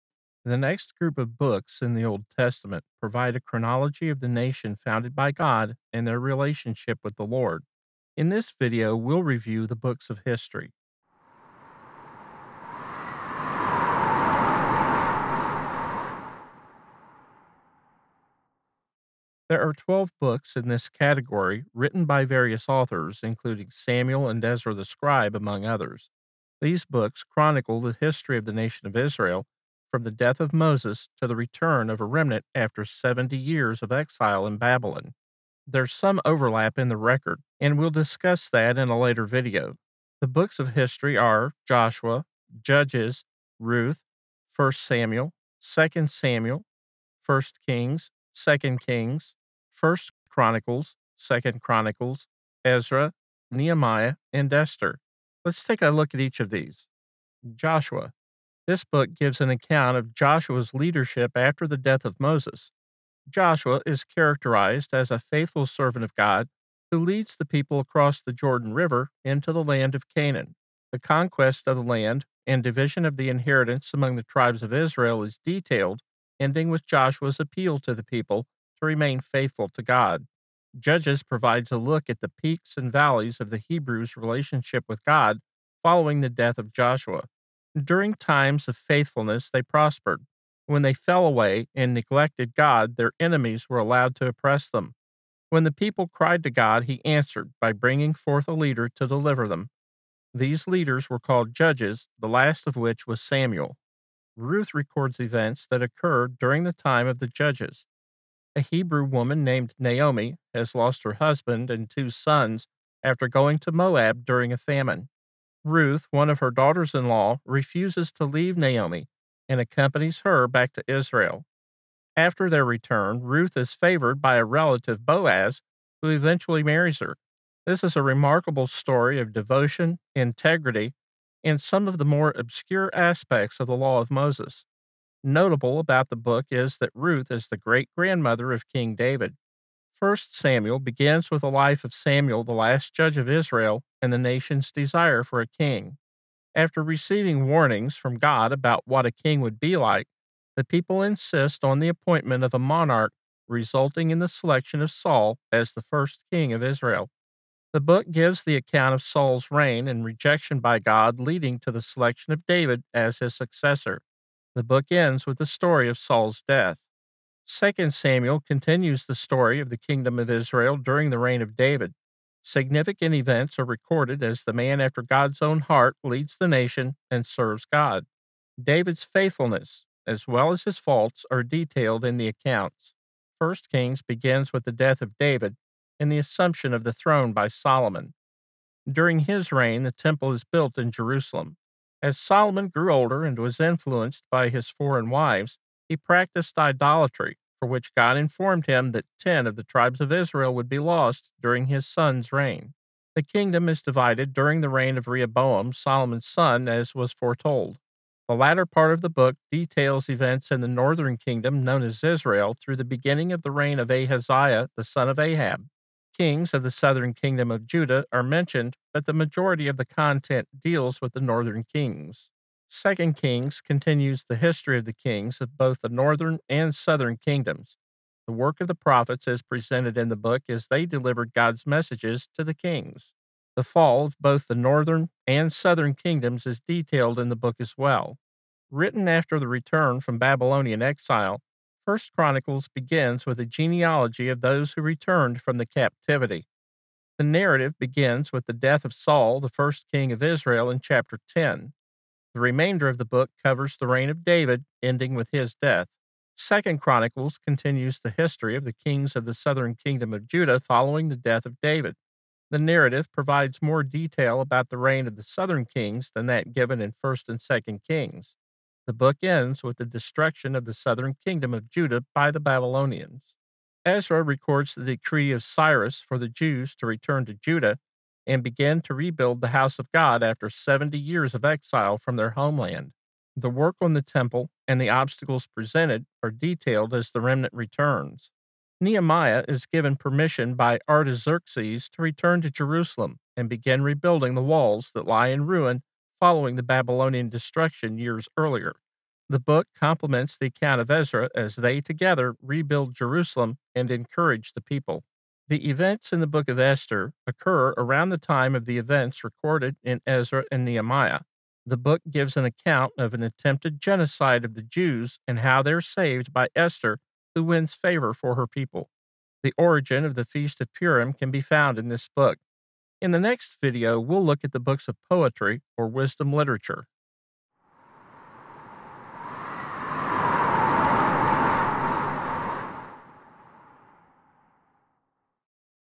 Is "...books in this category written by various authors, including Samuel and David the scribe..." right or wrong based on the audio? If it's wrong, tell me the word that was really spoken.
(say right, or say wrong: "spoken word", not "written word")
wrong: "Ezra", not "David".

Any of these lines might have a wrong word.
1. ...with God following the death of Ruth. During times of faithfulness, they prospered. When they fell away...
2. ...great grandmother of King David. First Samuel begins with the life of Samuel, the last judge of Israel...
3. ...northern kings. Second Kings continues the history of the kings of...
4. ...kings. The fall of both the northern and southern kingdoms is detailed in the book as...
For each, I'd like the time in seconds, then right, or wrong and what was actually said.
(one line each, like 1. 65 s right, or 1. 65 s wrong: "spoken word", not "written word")
1. 84 s wrong: "Joshua", not "Ruth"
2. 137 s right
3. 221 s right
4. 232 s right.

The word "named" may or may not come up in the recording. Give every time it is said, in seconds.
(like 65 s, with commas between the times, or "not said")
109 s.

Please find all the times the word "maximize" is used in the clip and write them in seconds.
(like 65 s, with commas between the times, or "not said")
not said.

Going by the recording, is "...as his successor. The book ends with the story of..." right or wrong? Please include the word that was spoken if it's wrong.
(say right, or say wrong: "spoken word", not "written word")
right.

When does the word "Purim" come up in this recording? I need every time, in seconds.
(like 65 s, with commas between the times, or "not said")
320 s.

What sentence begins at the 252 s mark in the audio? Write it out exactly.
The remainder of the book covers the reign of David, ending with his death.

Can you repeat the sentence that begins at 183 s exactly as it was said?
1 Kings begins with the death of David and the assumption of the throne by Solomon.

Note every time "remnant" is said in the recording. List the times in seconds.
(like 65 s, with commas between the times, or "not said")
32 s, 287 s.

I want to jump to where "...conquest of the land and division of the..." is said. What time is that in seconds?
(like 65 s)
70 s.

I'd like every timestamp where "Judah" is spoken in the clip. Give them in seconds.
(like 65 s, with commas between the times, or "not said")
217 s, 260 s, 271 s, 277 s.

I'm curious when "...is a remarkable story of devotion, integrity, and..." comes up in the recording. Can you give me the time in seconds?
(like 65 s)
127 s.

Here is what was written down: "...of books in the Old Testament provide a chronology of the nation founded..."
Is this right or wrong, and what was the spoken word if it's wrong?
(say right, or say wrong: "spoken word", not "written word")
right.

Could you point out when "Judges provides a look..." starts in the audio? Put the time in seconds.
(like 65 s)
80 s.